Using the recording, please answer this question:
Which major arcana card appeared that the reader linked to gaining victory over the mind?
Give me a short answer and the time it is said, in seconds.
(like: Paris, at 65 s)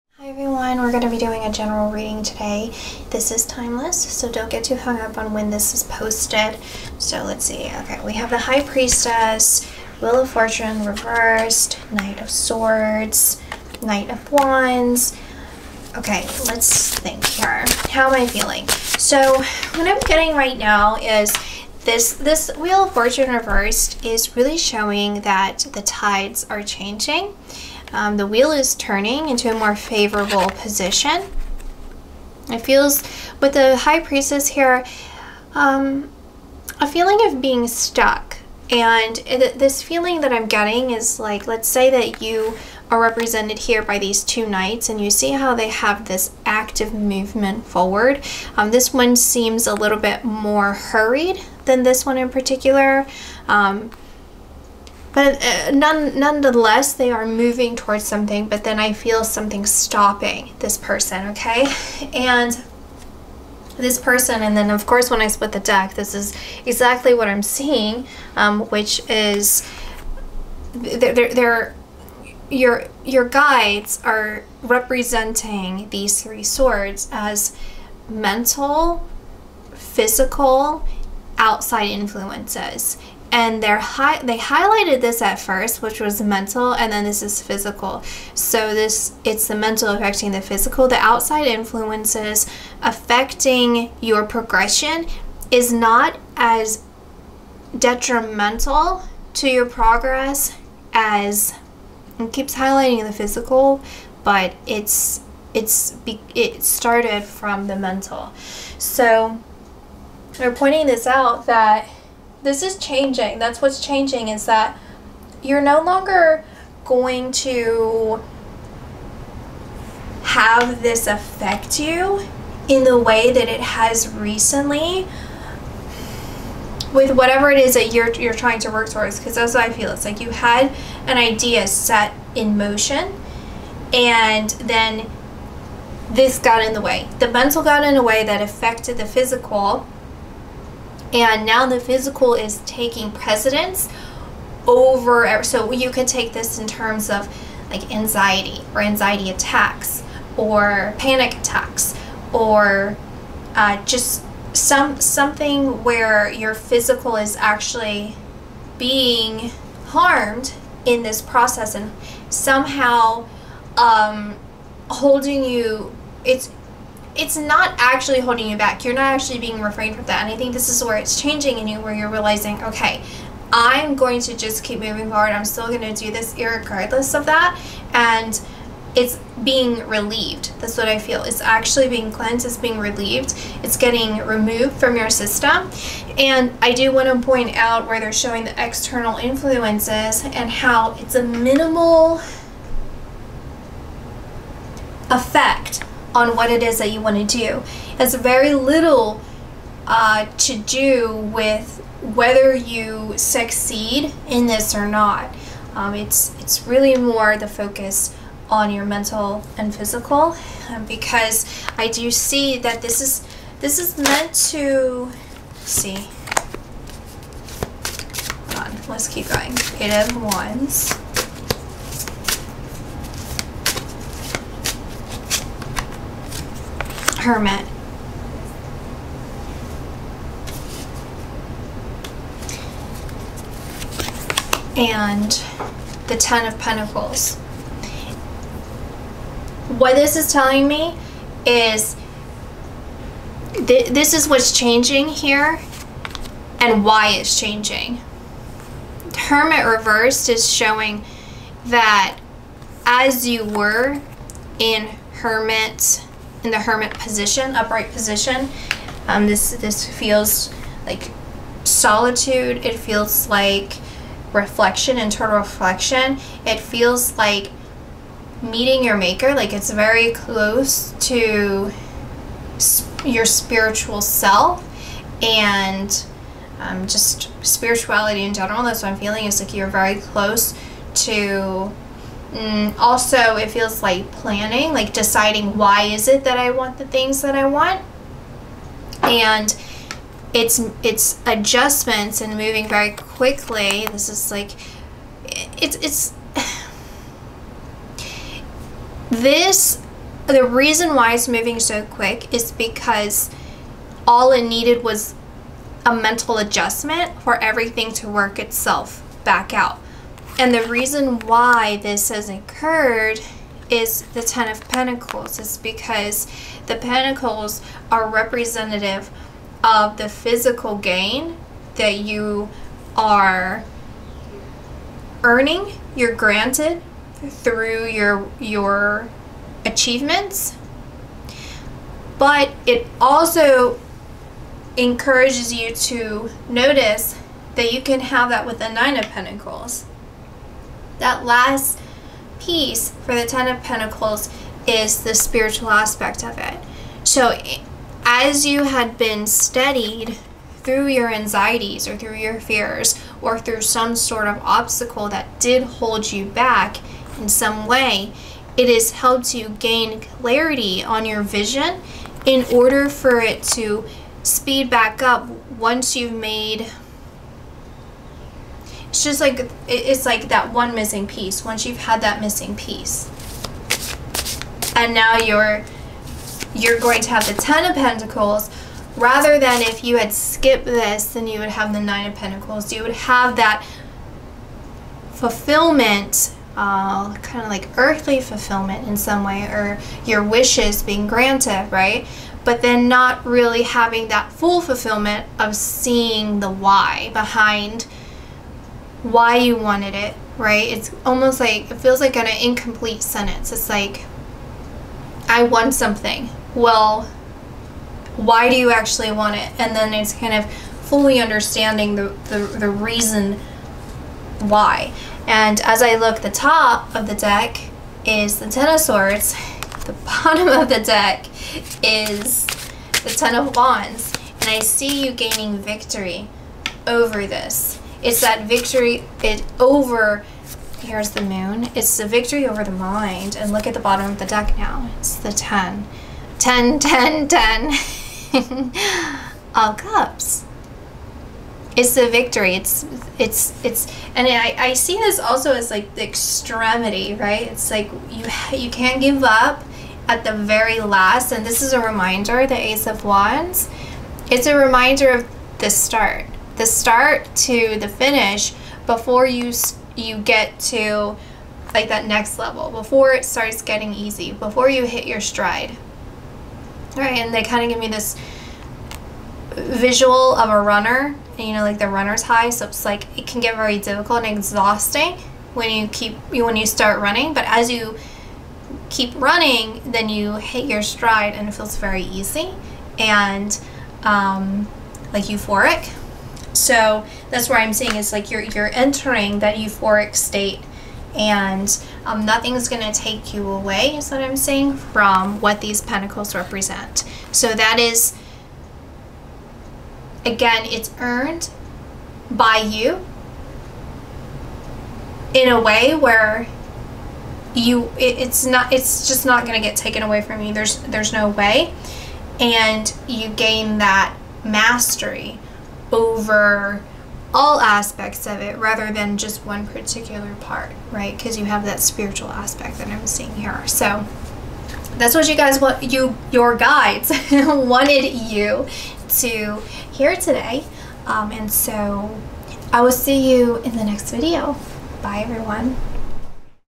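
The Moon, at 431 s.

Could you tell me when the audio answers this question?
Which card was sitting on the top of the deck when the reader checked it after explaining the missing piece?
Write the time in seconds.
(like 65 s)
418 s.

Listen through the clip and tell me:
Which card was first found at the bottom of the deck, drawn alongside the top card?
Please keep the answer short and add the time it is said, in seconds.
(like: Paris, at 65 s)
Ten of Wands, at 423 s.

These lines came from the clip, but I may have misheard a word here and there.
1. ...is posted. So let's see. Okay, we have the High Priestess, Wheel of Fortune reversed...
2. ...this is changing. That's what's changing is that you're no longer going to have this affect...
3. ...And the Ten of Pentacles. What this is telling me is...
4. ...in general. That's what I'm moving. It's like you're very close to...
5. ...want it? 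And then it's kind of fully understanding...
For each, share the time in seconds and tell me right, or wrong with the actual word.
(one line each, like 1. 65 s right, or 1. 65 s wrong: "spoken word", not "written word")
1. 5 s right
2. 112 s right
3. 234 s right
4. 278 s wrong: "feeling", not "moving"
5. 409 s right.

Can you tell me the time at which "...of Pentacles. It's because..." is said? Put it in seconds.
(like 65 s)
314 s.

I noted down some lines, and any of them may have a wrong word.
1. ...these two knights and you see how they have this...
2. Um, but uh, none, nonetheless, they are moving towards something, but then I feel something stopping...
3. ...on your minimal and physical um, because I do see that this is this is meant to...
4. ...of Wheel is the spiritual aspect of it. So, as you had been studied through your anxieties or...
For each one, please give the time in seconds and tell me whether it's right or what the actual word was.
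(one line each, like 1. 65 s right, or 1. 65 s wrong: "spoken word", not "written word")
1. 43 s right
2. 53 s right
3. 208 s wrong: "mental", not "minimal"
4. 343 s wrong: "Pentacles", not "Wheel".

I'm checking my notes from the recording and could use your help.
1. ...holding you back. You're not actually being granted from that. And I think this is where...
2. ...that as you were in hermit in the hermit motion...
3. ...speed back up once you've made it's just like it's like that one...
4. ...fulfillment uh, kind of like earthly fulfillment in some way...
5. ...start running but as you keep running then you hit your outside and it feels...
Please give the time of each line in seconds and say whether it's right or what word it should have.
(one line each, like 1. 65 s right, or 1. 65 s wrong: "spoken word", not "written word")
1. 168 s wrong: "refrained", not "granted"
2. 251 s wrong: "position", not "motion"
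3. 364 s right
4. 385 s right
5. 476 s wrong: "stride", not "outside".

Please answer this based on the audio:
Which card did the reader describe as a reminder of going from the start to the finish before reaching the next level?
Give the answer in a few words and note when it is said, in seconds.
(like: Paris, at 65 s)
Ace of Wands, at 452 s.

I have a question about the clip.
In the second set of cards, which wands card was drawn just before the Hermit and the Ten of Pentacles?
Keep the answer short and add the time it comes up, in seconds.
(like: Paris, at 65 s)
Eight of Wands, at 219 s.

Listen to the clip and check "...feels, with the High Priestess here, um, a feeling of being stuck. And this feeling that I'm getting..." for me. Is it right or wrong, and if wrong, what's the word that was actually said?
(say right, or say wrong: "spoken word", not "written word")
right.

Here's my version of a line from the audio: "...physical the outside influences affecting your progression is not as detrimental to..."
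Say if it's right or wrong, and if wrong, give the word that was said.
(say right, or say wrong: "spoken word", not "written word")
right.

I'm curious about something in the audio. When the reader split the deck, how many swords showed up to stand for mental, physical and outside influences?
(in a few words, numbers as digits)
3.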